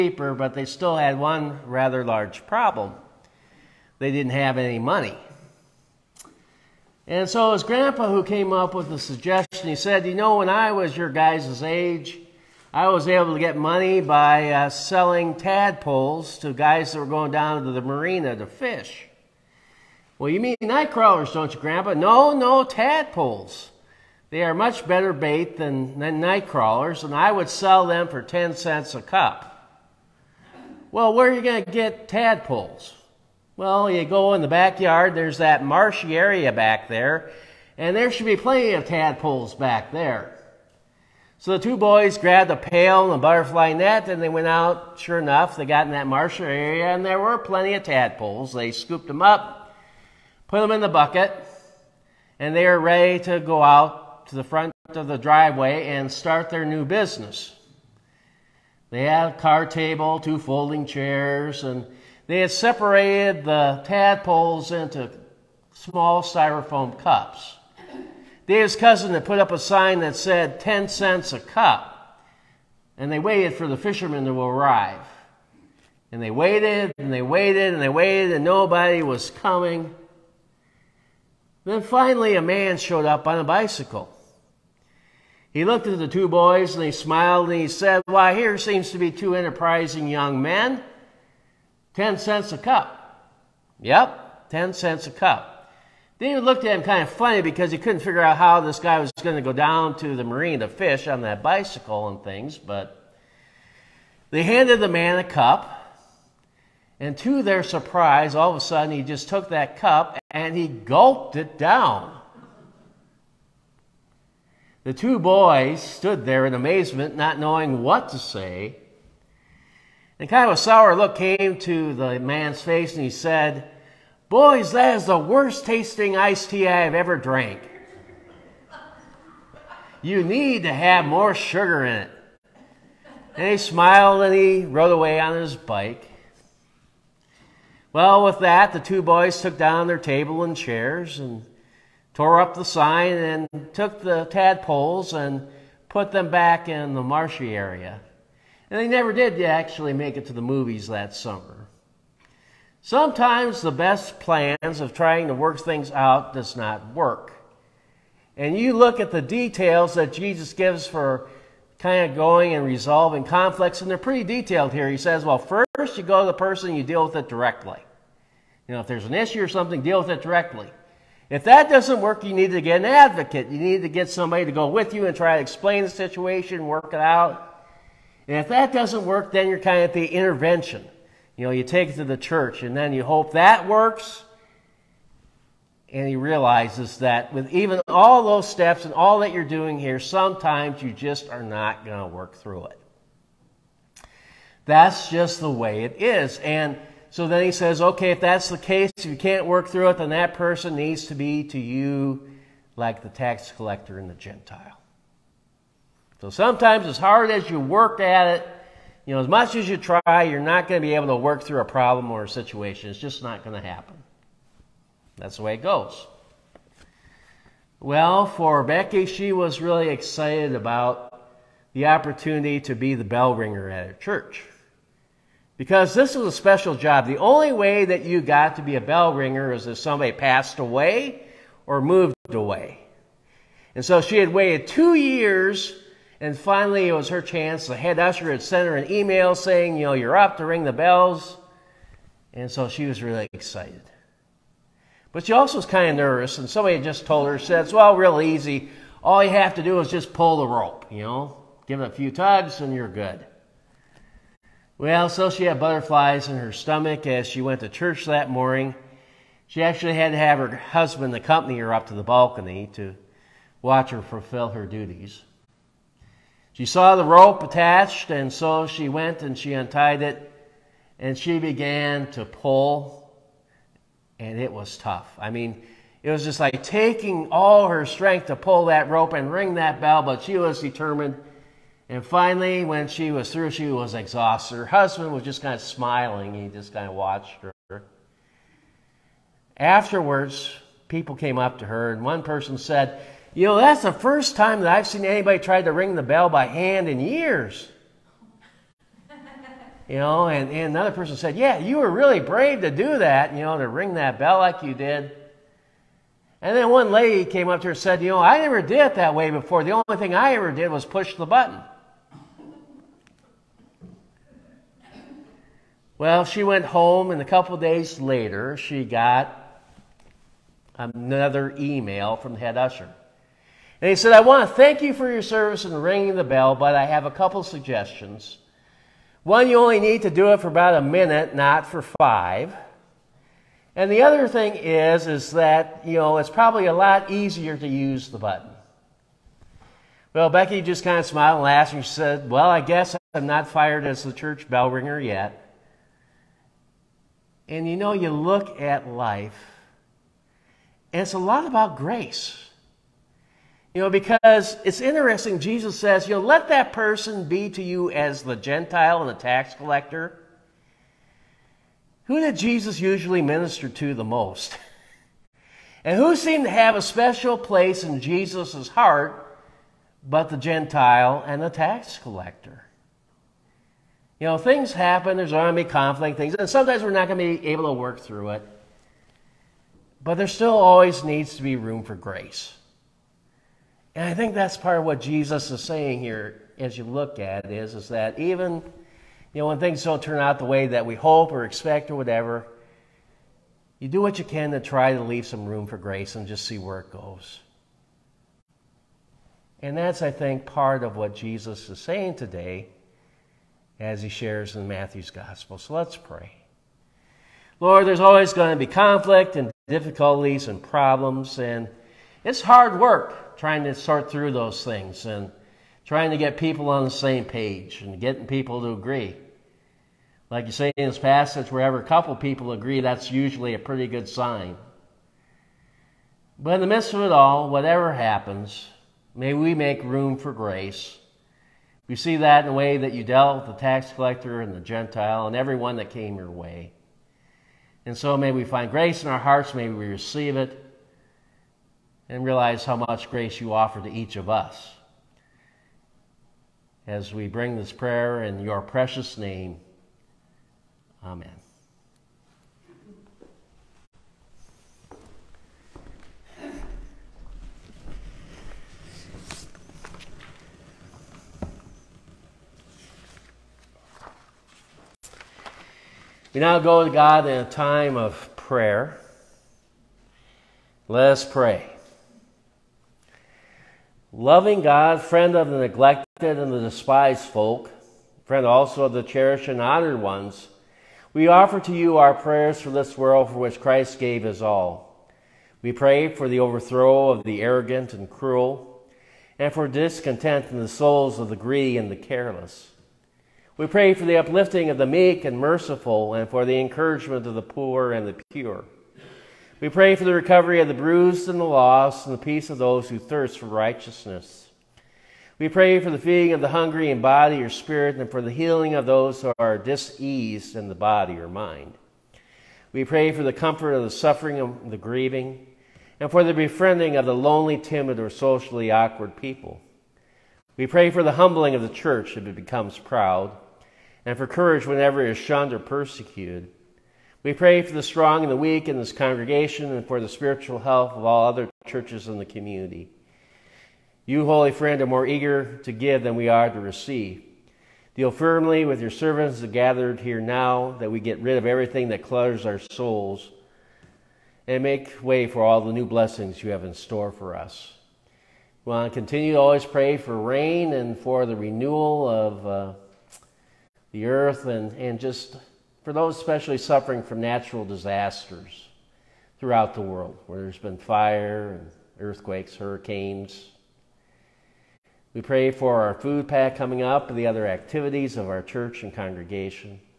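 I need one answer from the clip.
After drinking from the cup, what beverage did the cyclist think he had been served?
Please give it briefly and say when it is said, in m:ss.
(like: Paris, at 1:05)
iced tea, at 2:06.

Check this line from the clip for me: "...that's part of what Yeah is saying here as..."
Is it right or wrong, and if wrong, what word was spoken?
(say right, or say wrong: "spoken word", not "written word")
wrong: "Jesus", not "Yeah".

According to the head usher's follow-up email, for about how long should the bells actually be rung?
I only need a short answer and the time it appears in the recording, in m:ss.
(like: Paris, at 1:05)
about a minute, at 5:30.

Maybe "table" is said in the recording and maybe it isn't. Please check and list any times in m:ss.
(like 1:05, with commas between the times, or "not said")
0:59, 2:19.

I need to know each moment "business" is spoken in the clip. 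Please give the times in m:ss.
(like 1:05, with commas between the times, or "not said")
0:56.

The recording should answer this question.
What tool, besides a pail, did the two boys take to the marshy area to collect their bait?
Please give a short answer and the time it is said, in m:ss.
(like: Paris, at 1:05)
butterfly net, at 0:43.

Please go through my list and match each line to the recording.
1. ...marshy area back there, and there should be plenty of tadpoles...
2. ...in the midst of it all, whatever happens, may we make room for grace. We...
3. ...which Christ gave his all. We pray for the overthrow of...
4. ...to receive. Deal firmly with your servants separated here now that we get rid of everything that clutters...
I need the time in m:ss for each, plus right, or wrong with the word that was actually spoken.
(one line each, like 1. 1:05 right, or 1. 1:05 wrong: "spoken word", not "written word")
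1. 0:35 right
2. 7:06 right
3. 8:03 right
4. 8:56 wrong: "gathered", not "separated".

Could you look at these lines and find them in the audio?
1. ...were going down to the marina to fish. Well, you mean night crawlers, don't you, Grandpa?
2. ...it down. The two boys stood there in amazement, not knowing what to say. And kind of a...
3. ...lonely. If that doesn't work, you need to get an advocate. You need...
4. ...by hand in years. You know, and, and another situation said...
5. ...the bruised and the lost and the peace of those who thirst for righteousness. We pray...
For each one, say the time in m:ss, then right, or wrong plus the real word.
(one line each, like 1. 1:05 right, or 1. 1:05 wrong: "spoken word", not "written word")
1. 0:16 right
2. 1:51 right
3. 2:50 wrong: "directly", not "lonely"
4. 4:56 wrong: "person", not "situation"
5. 8:20 right.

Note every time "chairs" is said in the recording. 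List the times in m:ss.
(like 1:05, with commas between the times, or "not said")
1:00, 2:20.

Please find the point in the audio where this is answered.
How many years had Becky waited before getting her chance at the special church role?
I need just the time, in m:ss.
3:54.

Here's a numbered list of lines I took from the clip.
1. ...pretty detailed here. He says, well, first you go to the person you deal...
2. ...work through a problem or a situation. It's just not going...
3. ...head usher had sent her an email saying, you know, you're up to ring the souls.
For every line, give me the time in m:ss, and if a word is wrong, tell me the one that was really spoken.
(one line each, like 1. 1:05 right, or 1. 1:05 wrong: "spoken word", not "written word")
1. 2:43 right
2. 3:31 right
3. 3:57 wrong: "bells", not "souls".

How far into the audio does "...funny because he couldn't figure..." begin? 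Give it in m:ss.
1:37.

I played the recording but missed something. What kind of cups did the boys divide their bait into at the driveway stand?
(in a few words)
styrofoam cups.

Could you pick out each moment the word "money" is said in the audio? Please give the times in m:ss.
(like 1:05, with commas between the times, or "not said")
0:04, 0:13.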